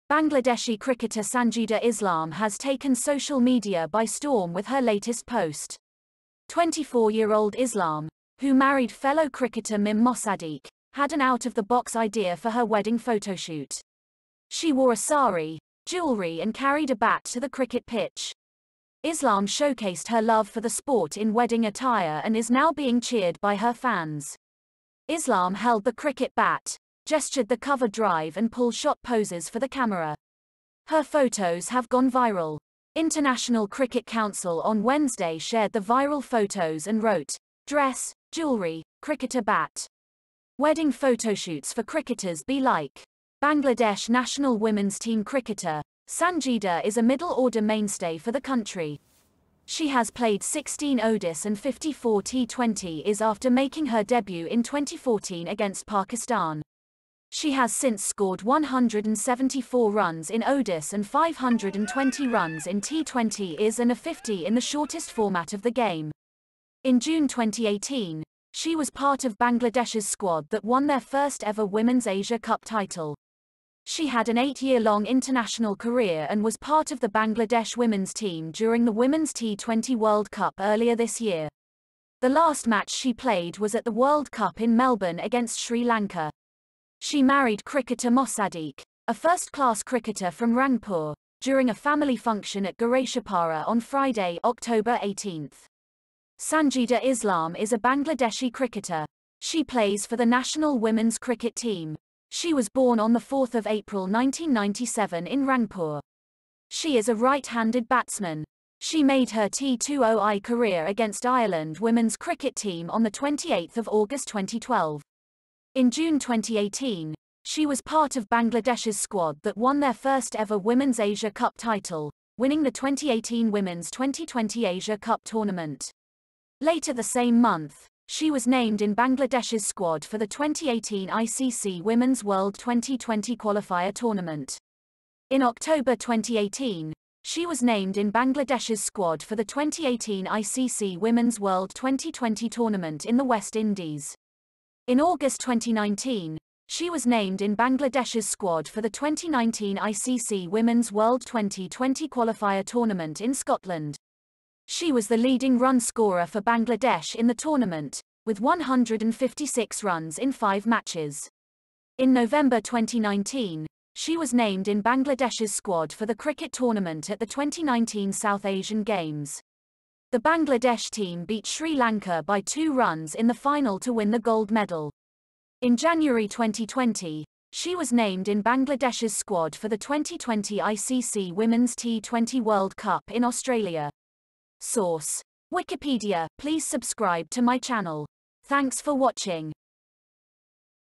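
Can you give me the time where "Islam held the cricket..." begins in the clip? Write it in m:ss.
0:25.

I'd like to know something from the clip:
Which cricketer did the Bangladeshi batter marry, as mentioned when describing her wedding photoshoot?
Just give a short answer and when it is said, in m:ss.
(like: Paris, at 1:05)
Mim Mosaddeak, at 0:09.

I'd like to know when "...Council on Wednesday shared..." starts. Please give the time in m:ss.
0:34.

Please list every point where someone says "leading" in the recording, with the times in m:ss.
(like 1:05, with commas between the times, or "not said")
2:35.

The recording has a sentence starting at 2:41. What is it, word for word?
In November 2019, she was named in Bangladesh's squad for the cricket tournament at the 2019 South Asian Games.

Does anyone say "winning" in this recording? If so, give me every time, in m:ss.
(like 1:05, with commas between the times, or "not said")
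2:02.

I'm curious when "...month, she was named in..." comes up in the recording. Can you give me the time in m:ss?
2:07.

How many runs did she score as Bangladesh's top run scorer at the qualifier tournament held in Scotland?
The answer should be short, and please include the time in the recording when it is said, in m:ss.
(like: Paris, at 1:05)
156, at 2:38.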